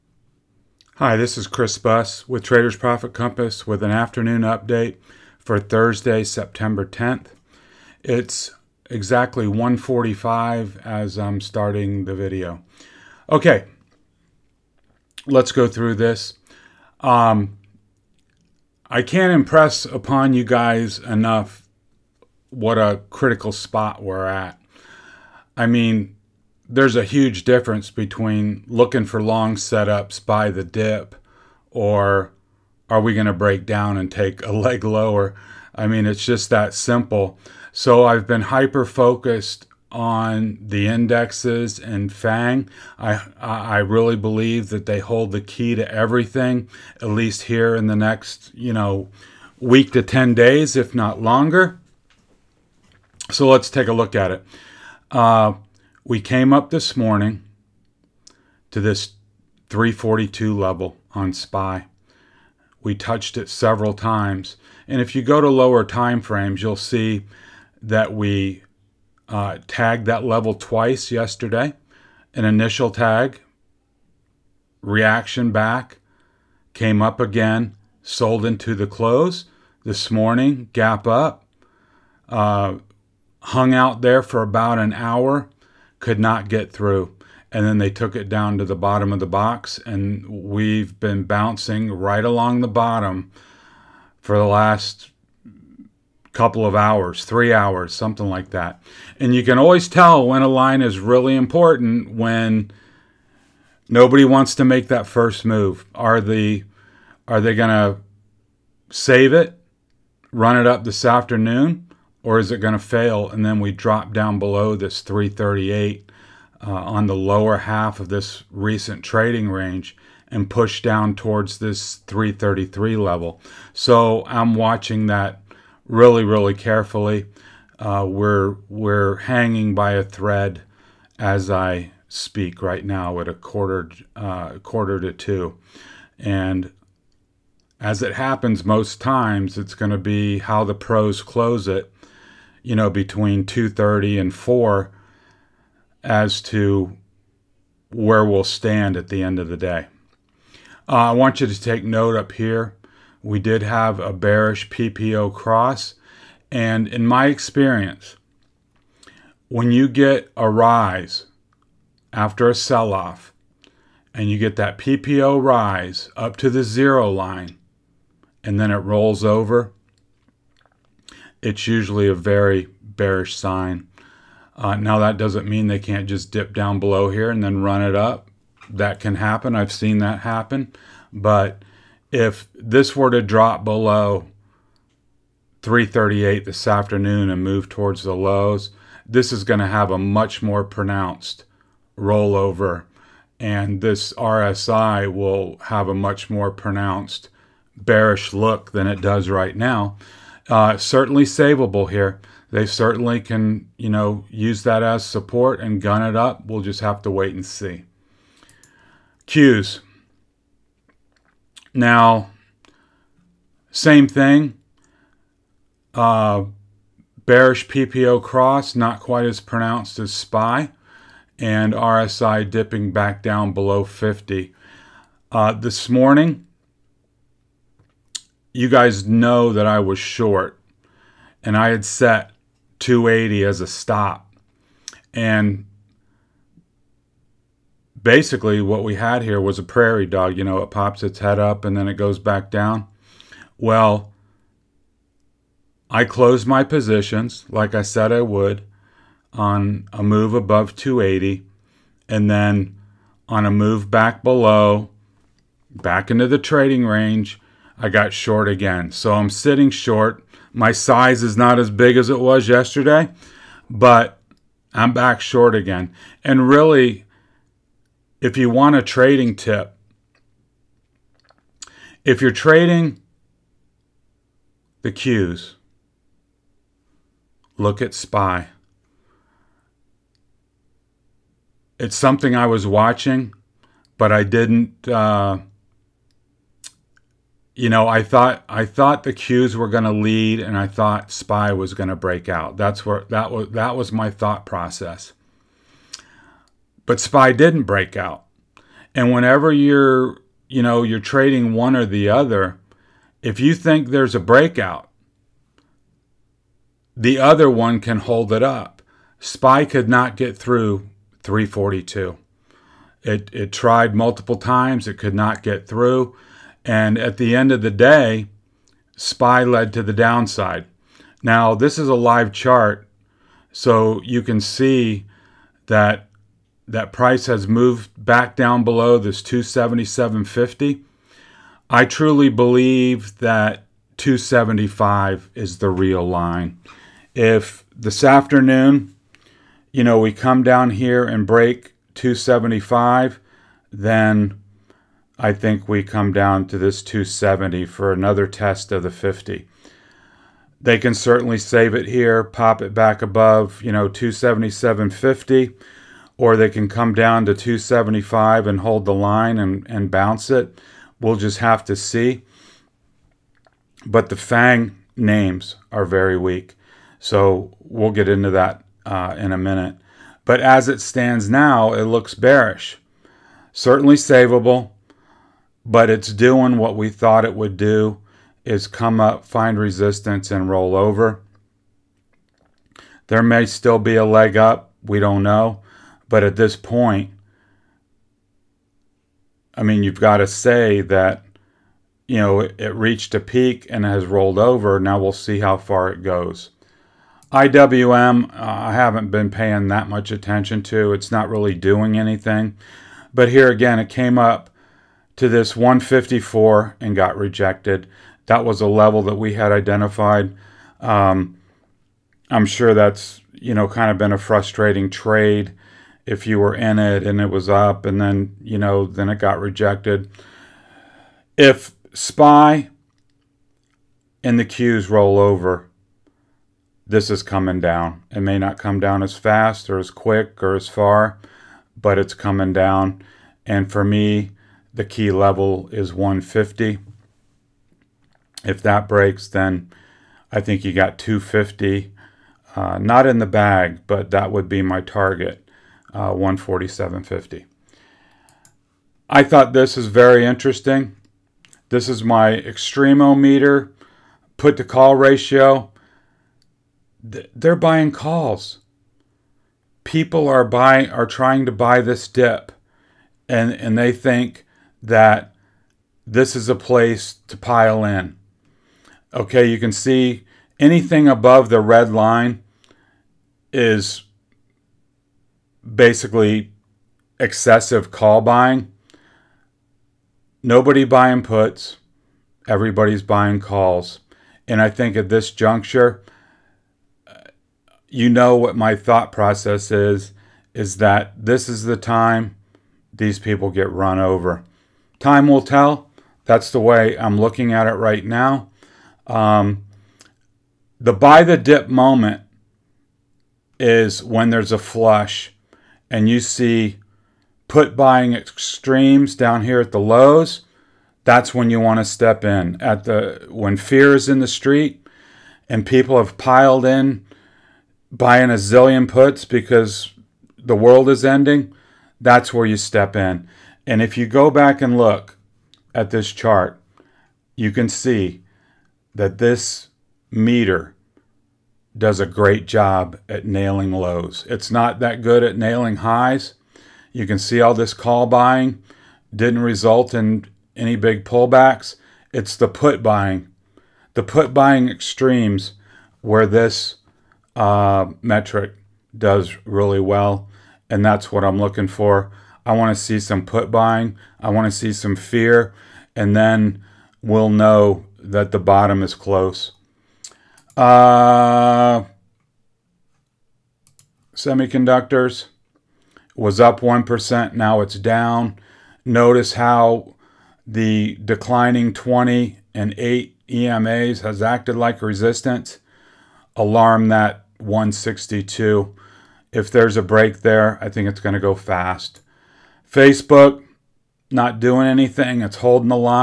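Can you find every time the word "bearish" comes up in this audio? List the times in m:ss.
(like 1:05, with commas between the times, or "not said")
2:34, 2:52, 3:17, 3:37, 6:12.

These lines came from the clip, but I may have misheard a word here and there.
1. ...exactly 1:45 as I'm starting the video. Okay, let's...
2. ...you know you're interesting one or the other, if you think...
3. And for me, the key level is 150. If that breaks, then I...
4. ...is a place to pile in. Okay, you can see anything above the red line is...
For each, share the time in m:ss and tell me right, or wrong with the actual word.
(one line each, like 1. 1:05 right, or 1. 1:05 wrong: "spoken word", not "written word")
1. 0:08 right
2. 5:00 wrong: "trading", not "interesting"
3. 7:13 right
4. 7:46 right.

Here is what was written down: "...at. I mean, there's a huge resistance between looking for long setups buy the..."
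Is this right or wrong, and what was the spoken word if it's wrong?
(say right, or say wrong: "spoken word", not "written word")
wrong: "difference", not "resistance".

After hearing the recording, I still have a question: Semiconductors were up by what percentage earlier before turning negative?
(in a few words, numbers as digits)
1%.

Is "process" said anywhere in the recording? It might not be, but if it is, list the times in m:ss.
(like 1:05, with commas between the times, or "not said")
4:54, 8:09.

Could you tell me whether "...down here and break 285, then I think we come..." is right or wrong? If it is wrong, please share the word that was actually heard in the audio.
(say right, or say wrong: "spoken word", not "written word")
wrong: "275", not "285".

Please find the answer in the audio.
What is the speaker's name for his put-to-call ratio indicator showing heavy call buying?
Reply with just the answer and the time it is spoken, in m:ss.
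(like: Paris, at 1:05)
Extremo meter, at 7:32.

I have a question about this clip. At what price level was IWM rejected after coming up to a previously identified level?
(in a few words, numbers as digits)
154.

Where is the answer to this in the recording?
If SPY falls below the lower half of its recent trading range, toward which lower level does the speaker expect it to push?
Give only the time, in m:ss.
2:02.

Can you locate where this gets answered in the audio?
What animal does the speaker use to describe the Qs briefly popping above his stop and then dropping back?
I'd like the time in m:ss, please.
3:59.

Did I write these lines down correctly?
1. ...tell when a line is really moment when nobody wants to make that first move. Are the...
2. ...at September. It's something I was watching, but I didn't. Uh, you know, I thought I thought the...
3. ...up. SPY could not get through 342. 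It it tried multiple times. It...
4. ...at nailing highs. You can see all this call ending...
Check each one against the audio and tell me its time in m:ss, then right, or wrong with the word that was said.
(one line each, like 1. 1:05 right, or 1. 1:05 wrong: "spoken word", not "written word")
1. 1:39 wrong: "important", not "moment"
2. 4:37 wrong: "SPY", not "September"
3. 5:08 right
4. 8:55 wrong: "buying", not "ending".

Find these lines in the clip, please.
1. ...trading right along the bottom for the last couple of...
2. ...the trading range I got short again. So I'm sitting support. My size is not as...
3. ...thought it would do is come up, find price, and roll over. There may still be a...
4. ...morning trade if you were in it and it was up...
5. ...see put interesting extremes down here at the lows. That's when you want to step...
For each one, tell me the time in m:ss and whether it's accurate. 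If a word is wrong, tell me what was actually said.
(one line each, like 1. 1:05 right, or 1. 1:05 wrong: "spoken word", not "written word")
1. 1:31 wrong: "bouncing", not "trading"
2. 4:16 wrong: "short", not "support"
3. 6:16 wrong: "resistance", not "price"
4. 6:54 wrong: "frustrating", not "morning"
5. 8:26 wrong: "buying", not "interesting".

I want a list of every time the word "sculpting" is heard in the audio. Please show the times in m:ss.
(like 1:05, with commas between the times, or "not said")
not said.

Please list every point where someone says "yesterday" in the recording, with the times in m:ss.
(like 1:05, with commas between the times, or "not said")
1:11, 4:22.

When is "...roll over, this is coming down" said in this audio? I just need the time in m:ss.
7:04.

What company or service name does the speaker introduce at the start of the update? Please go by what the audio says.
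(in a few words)
Traders Profit Compass.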